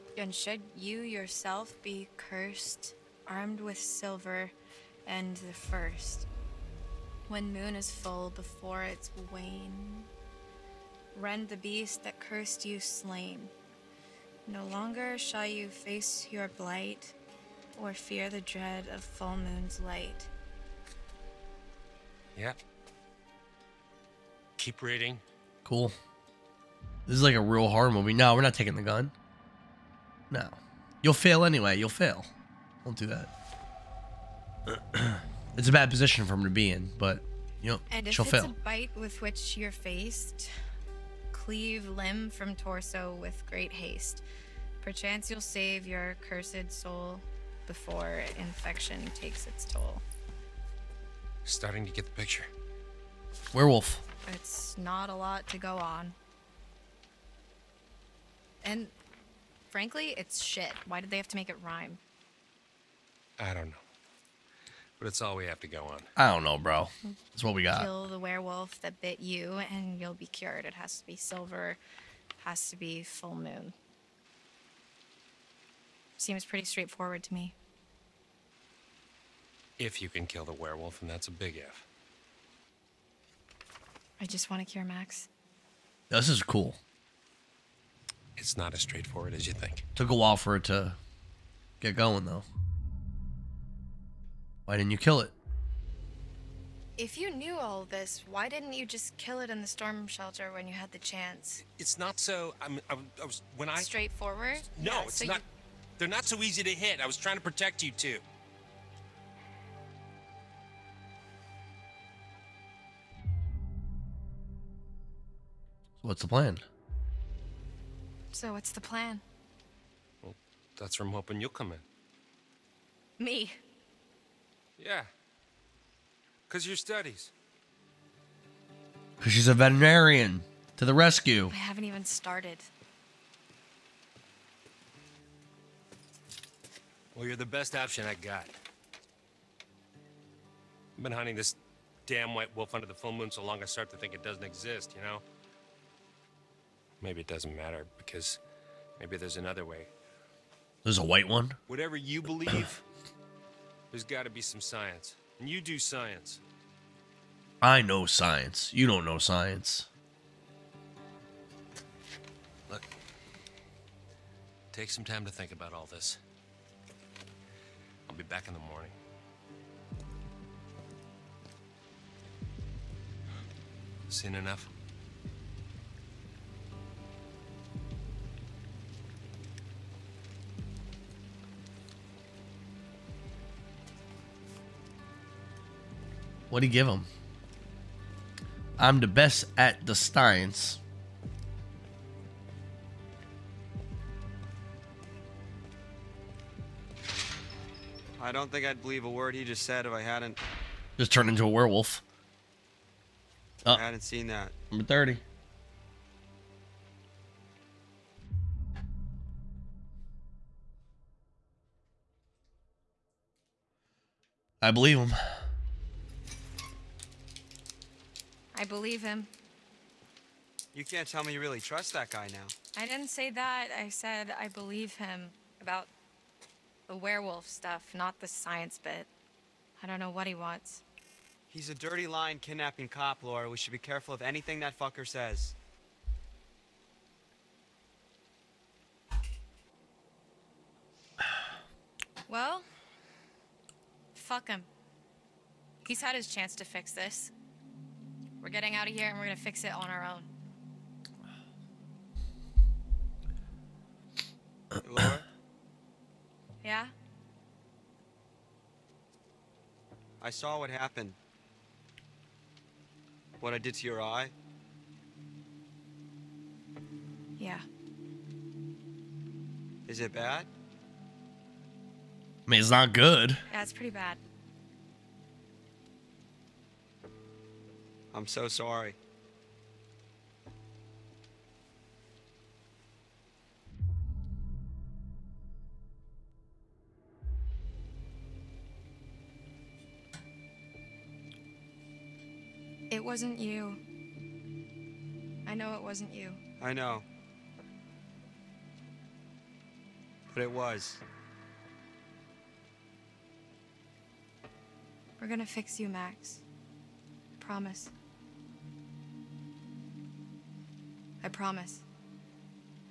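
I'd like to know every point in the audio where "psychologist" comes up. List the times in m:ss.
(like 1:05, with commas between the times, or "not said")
not said.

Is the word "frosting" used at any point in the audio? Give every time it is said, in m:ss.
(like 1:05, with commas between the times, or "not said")
not said.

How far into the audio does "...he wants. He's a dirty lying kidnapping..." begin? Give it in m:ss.
3:50.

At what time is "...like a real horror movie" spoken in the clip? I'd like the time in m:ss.
0:27.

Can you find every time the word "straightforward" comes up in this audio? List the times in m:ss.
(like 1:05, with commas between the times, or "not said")
1:16, 1:28, 1:43.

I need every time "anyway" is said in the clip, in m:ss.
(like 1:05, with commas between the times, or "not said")
0:31.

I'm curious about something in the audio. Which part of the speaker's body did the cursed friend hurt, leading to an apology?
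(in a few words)
Eye.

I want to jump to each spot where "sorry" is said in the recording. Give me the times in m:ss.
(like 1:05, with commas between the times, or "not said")
4:38.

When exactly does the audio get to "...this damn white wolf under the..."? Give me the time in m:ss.
2:21.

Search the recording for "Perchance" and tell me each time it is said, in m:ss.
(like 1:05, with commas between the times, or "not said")
0:44.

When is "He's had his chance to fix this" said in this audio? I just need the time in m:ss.
4:05.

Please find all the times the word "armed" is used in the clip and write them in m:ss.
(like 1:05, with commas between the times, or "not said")
0:03.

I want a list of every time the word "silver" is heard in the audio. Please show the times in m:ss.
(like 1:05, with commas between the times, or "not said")
0:03, 1:11.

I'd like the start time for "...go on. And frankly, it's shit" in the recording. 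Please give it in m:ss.
0:55.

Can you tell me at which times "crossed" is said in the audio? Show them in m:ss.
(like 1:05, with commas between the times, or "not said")
not said.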